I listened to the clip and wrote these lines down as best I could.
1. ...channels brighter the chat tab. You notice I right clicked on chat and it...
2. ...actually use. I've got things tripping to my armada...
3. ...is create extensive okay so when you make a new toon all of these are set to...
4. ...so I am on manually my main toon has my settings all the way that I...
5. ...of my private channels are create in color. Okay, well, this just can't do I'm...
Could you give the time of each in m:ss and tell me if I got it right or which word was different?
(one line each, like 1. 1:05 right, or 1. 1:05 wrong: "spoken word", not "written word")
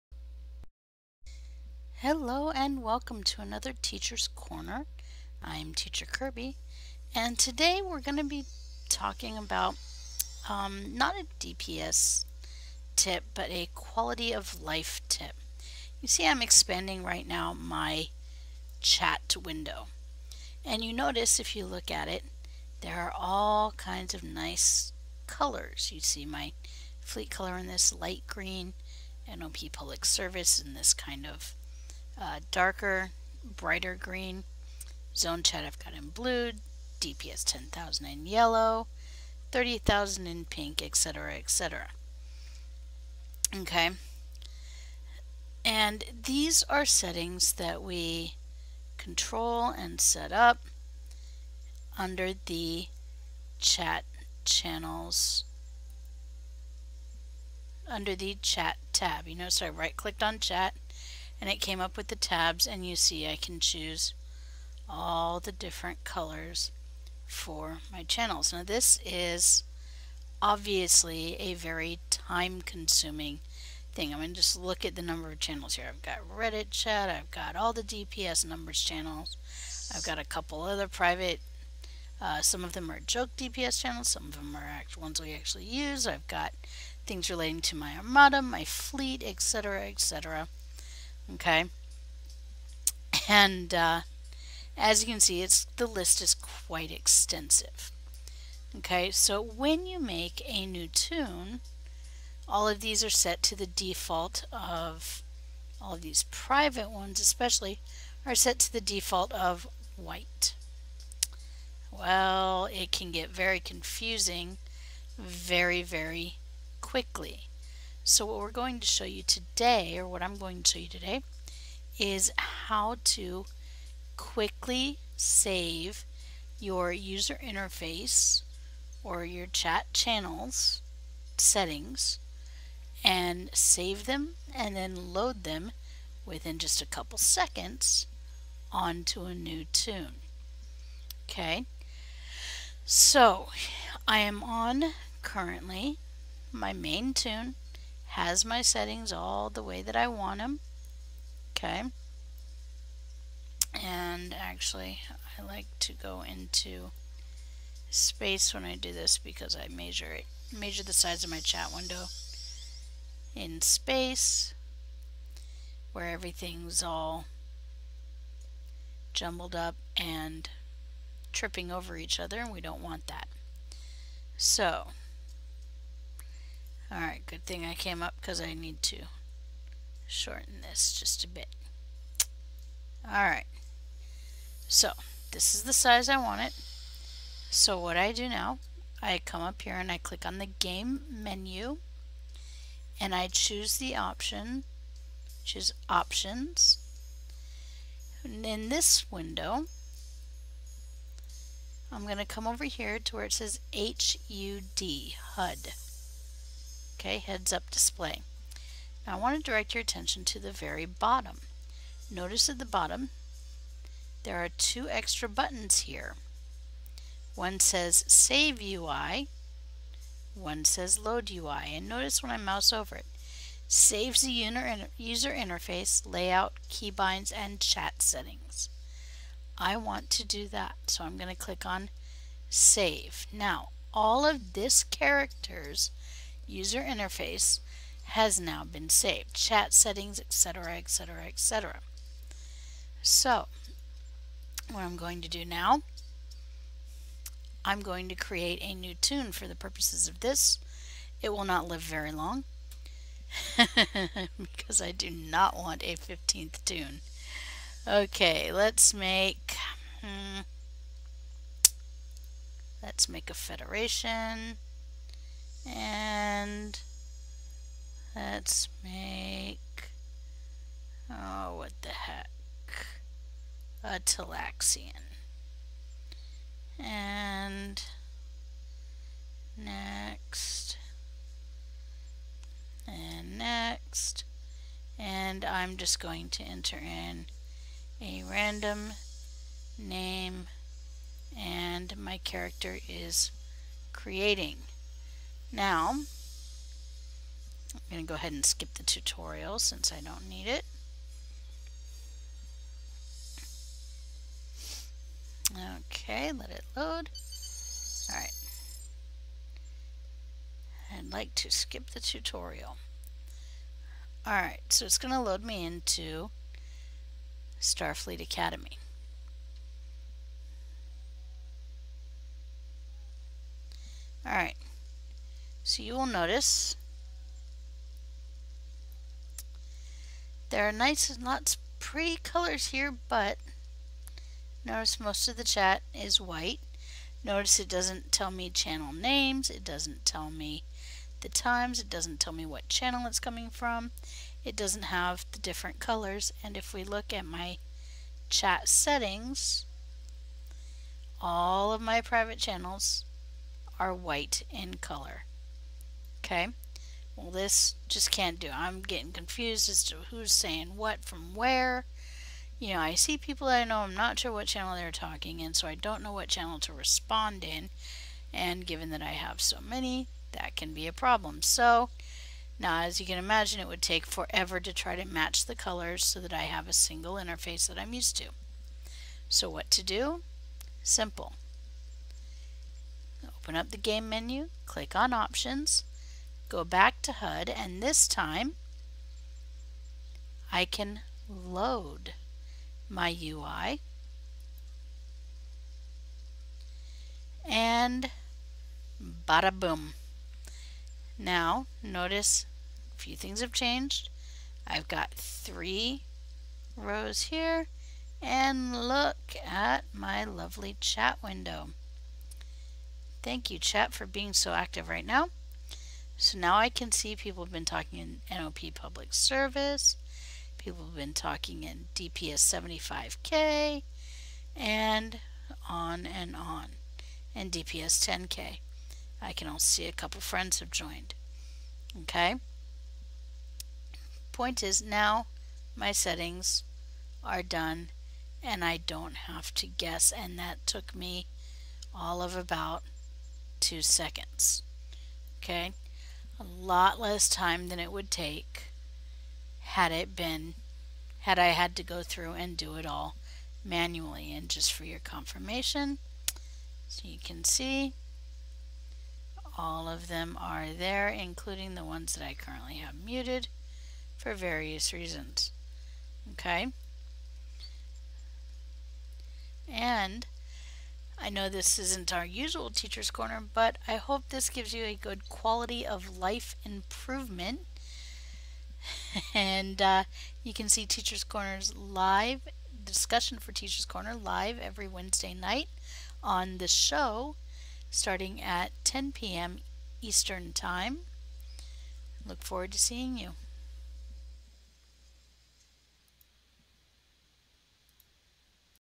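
1. 0:54 wrong: "under", not "brighter"
2. 1:25 wrong: "relating", not "tripping"
3. 1:36 wrong: "quite", not "create"
4. 2:22 wrong: "currently", not "manually"
5. 5:51 wrong: "white", not "create".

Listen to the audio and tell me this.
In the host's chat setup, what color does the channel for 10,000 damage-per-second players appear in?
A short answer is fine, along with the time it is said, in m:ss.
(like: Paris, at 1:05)
yellow, at 0:38.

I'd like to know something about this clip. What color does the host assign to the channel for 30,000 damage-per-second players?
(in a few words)
pink.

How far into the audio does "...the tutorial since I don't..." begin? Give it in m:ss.
4:58.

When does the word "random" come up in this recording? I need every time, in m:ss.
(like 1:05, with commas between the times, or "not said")
4:48.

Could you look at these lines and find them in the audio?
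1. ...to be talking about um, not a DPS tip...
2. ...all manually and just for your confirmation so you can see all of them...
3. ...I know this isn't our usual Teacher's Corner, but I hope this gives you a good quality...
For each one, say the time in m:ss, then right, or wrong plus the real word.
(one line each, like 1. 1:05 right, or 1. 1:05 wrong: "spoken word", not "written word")
1. 0:08 right
2. 7:32 right
3. 7:51 right.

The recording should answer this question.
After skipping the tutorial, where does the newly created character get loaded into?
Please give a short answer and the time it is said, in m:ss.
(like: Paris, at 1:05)
Starfleet Academy, at 5:17.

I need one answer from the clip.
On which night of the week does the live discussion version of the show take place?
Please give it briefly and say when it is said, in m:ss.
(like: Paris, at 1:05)
Wednesday, at 8:04.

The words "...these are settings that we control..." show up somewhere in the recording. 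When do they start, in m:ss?
0:46.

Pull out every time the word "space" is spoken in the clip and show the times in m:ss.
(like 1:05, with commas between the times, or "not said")
2:37, 2:43.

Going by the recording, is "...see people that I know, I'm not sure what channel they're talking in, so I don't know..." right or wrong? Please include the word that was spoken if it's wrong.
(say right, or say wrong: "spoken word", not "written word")
right.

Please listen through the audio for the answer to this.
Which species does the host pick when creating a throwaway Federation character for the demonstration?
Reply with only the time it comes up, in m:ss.
4:33.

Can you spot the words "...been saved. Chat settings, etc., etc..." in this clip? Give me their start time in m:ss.
3:58.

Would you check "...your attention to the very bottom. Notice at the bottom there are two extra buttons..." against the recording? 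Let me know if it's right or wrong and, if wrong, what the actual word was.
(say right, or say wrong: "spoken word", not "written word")
right.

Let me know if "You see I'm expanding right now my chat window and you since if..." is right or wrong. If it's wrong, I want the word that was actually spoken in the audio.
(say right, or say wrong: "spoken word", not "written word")
wrong: "notice", not "since".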